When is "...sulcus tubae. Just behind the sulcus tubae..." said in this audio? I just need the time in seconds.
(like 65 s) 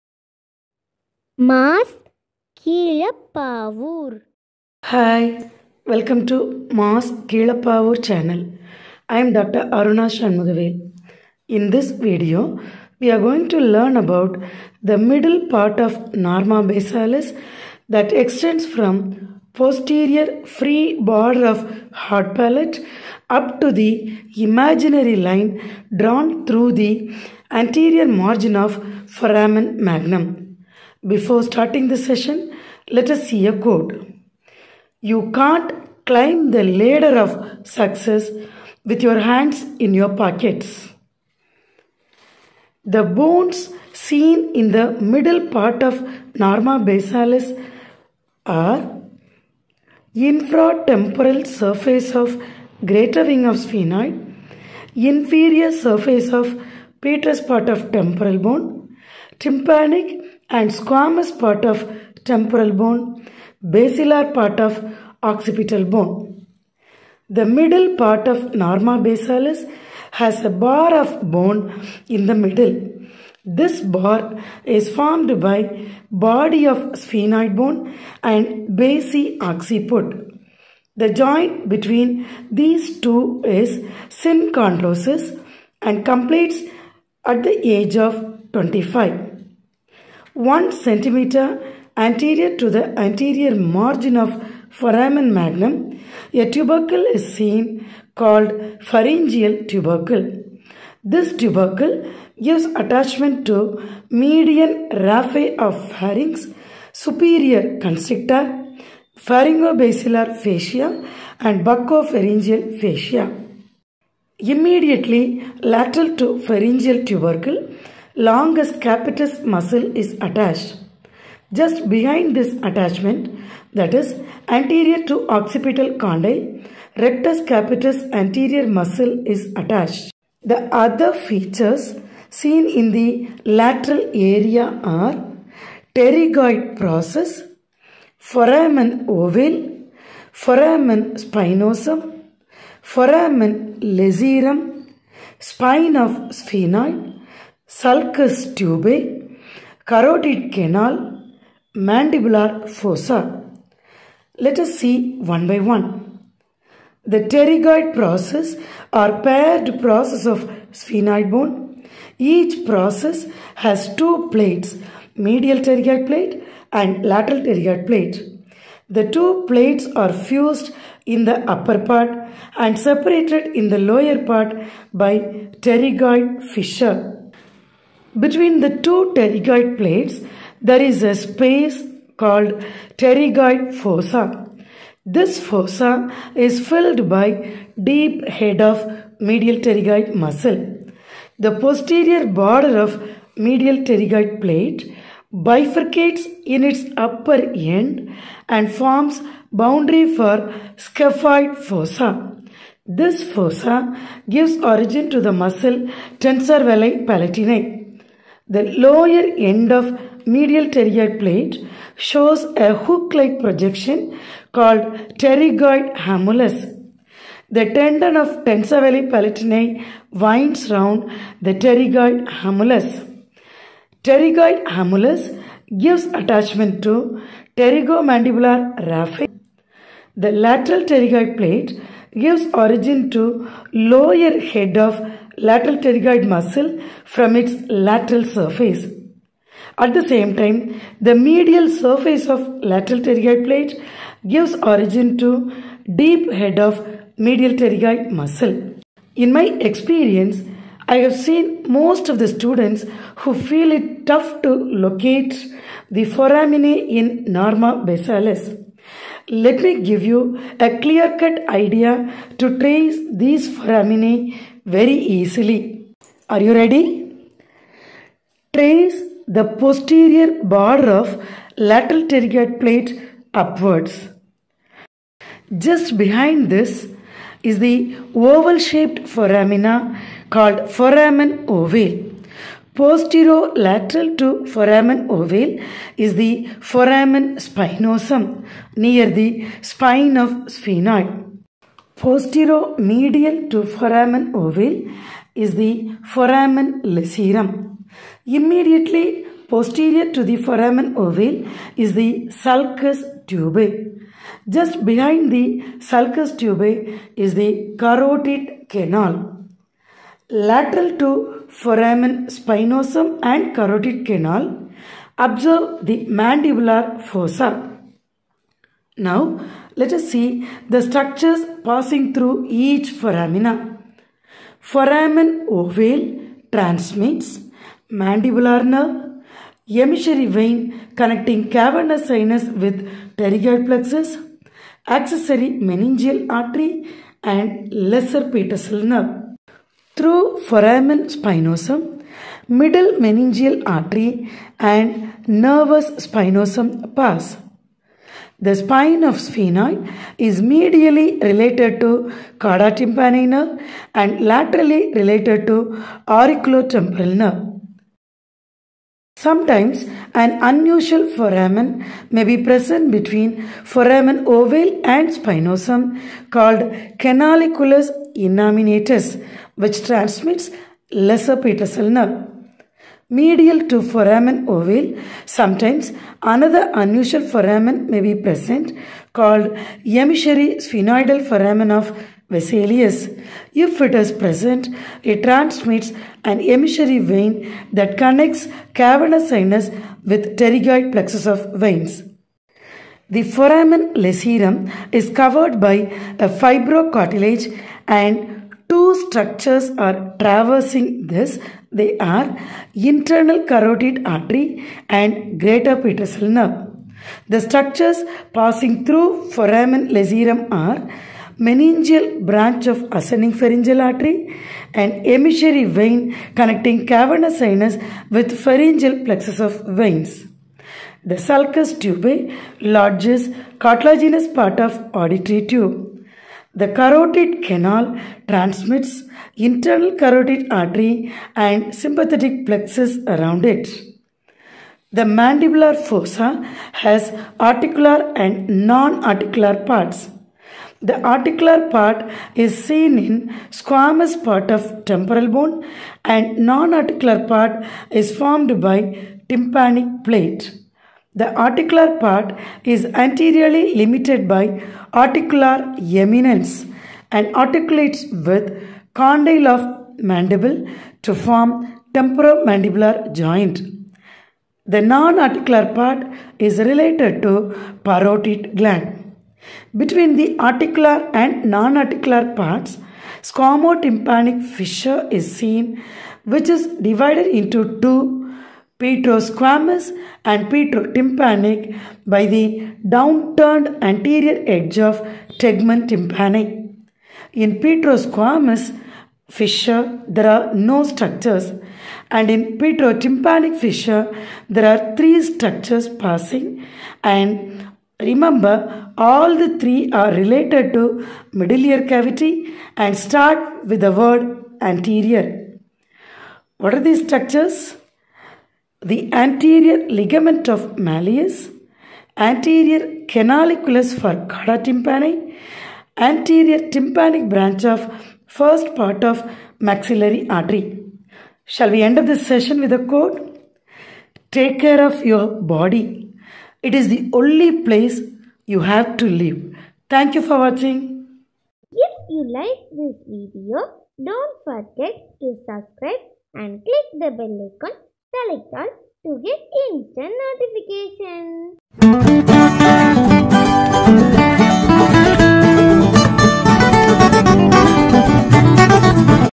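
302 s.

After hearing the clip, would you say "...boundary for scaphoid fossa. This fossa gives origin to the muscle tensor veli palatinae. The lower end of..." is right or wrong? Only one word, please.
right.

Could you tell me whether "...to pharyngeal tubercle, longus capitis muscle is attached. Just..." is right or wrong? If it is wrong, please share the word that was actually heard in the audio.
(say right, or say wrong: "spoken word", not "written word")
right.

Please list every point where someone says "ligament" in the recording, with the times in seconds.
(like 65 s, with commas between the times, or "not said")
509 s.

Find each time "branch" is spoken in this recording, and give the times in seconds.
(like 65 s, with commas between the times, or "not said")
412 s, 517 s.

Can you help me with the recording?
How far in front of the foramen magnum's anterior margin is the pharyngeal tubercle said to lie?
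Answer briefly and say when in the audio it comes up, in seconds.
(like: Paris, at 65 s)
1 centimeter, at 90 s.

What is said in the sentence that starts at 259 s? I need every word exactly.
Let me give you a clear-cut idea to trace these foraminae very easily.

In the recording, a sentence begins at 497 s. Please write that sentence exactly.
And remember, all the three are related to middle ear cavity and start with the word anterior.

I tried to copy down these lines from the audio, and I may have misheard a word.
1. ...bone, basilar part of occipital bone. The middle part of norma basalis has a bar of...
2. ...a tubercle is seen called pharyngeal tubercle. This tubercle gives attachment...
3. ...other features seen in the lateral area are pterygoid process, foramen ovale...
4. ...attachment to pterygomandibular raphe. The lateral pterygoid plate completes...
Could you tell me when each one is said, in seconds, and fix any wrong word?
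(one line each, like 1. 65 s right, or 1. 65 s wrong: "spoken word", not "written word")
1. 62 s right
2. 96 s right
3. 130 s right
4. 226 s wrong: "gives", not "completes".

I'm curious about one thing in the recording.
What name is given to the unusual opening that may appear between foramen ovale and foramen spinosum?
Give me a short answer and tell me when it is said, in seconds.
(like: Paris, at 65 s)
canaliculus innominatus, at 367 s.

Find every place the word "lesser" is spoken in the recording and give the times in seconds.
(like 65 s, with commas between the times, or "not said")
337 s, 370 s.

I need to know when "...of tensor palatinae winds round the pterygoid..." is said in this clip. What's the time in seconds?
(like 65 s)
218 s.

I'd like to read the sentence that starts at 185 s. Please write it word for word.
This fossa is filled by deep head of medial pterygoid muscle.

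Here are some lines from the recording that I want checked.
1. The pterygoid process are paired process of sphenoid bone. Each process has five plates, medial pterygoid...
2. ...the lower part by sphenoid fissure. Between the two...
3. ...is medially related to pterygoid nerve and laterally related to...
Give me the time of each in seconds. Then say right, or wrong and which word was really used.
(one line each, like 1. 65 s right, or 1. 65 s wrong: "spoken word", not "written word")
1. 157 s wrong: "two", not "five"
2. 173 s wrong: "pterygoid", not "sphenoid"
3. 350 s wrong: "carotid", not "pterygoid".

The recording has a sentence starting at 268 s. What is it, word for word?
Trace the posterior border of lateral pterygoid plate upwards.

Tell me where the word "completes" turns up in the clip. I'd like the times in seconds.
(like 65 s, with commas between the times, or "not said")
86 s.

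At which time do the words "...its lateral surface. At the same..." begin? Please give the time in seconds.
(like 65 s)
237 s.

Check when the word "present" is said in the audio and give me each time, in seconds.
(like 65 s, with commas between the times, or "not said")
362 s, 378 s, 384 s.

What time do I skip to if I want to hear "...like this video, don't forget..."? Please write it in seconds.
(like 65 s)
532 s.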